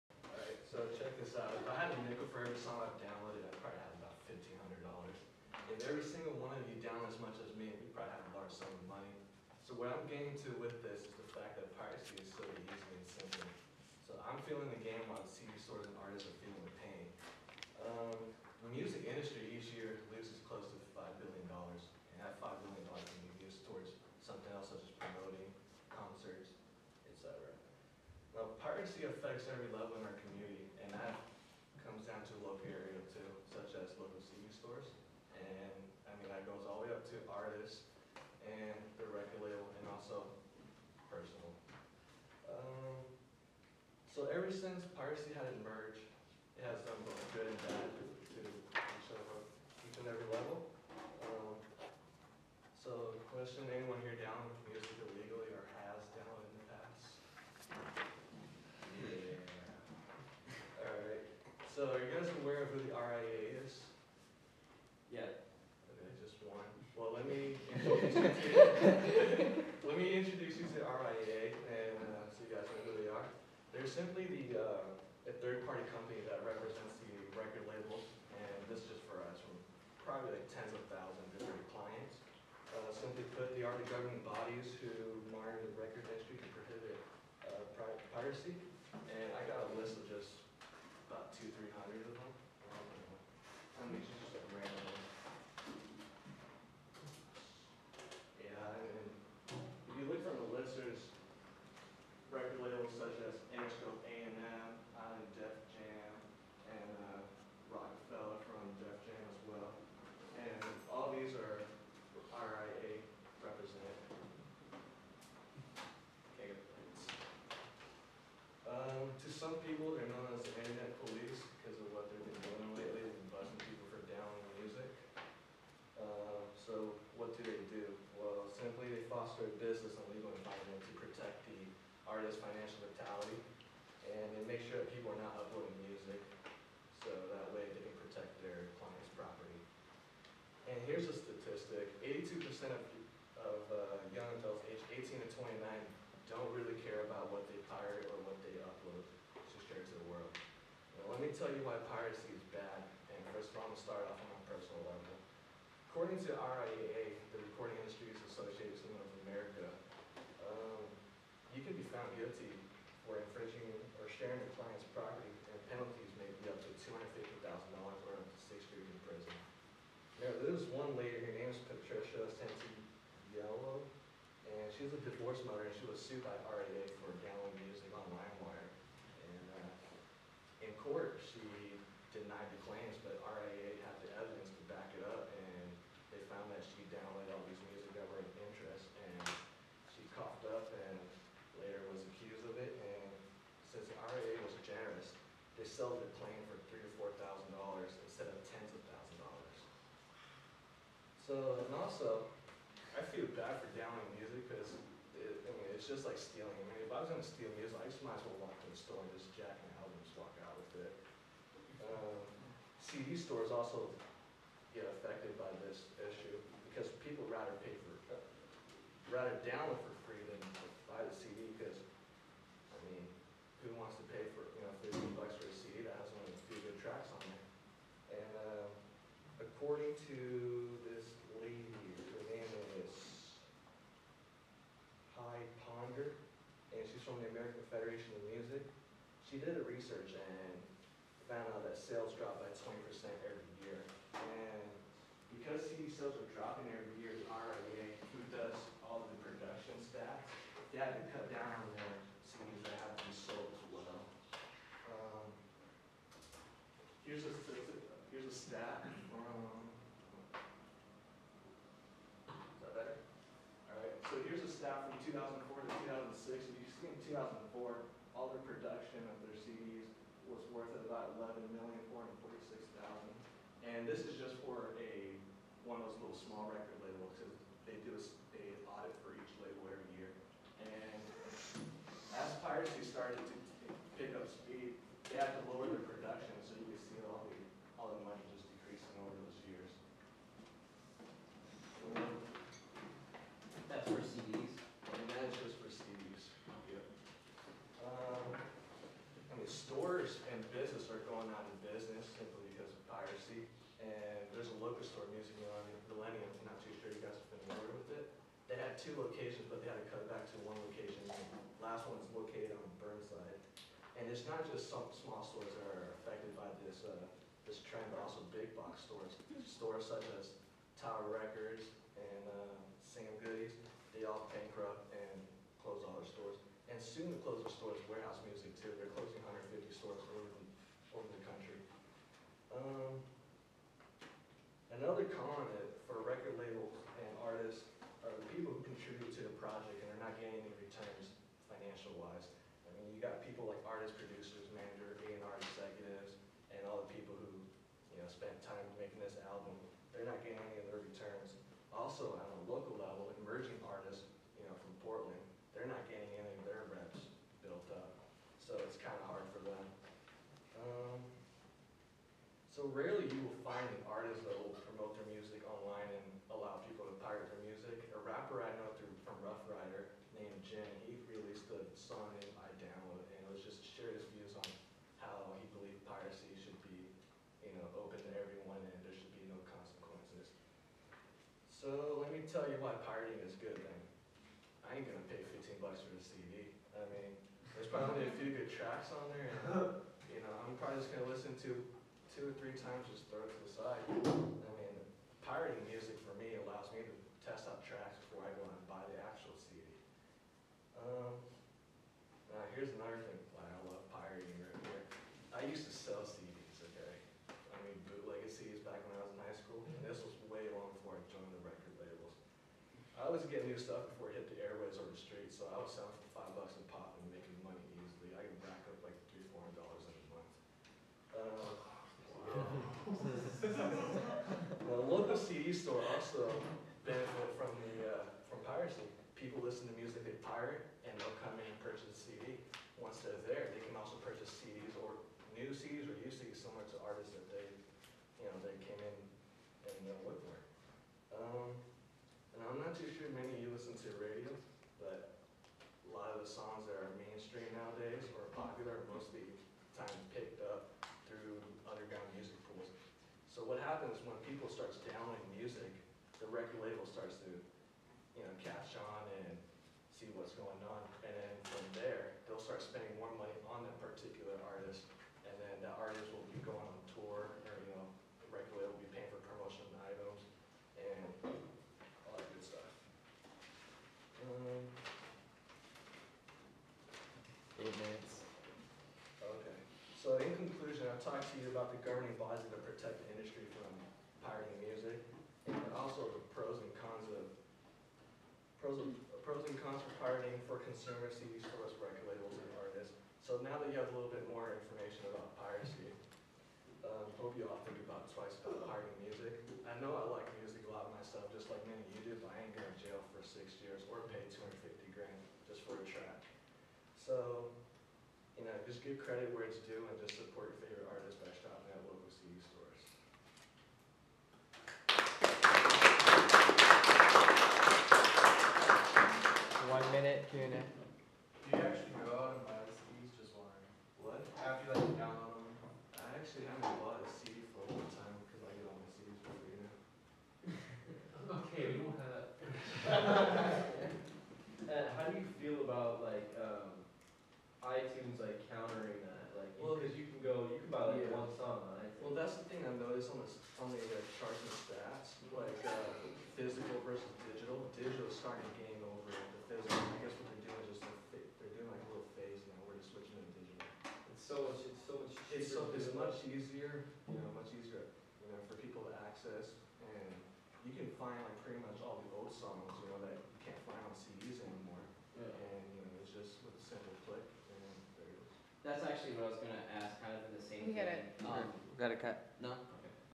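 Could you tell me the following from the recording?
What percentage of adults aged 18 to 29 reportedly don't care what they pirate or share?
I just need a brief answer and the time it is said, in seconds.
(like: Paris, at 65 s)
82%, at 142 s.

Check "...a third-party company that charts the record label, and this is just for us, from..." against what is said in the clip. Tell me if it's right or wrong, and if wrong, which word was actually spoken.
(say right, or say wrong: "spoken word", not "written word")
wrong: "represents", not "charts".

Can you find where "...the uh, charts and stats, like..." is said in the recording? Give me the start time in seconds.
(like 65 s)
543 s.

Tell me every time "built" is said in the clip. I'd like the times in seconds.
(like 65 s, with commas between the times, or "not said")
357 s.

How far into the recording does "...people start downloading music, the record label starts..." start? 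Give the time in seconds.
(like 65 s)
454 s.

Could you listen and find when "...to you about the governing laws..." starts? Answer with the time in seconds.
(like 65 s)
481 s.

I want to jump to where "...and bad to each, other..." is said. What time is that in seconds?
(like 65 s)
47 s.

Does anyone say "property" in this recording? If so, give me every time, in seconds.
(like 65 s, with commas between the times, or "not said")
139 s, 164 s.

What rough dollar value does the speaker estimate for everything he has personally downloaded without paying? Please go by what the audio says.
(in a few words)
$1,500.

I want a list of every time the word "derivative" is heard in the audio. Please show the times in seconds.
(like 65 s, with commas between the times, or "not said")
not said.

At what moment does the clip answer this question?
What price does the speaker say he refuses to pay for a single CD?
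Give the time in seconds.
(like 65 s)
385 s.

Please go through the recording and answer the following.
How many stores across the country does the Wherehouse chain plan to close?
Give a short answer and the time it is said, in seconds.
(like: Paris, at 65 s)
150, at 329 s.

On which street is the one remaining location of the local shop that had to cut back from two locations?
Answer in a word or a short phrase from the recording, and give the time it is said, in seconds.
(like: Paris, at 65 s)
Burnside, at 312 s.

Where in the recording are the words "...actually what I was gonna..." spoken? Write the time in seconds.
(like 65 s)
568 s.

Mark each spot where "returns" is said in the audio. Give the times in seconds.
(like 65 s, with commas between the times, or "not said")
340 s, 350 s.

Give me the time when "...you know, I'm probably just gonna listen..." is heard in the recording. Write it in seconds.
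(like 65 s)
390 s.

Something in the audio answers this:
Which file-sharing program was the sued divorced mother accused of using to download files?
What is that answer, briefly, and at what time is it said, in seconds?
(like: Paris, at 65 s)
LimeWire, at 178 s.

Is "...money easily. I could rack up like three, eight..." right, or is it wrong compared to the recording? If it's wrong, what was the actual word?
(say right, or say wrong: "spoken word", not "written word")
wrong: "four", not "eight".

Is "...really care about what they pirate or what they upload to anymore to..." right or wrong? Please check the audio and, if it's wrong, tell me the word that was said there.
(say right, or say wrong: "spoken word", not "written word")
wrong: "share", not "anymore".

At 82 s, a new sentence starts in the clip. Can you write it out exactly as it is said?
Uh, simply put, they are the governing bodies who monitor the record industry to prohibit uh, piracy.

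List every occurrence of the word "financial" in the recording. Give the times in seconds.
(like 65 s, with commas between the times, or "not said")
132 s, 341 s.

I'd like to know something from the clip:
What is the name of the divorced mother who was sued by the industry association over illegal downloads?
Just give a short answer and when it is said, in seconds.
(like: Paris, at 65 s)
Patricia Santiello, at 171 s.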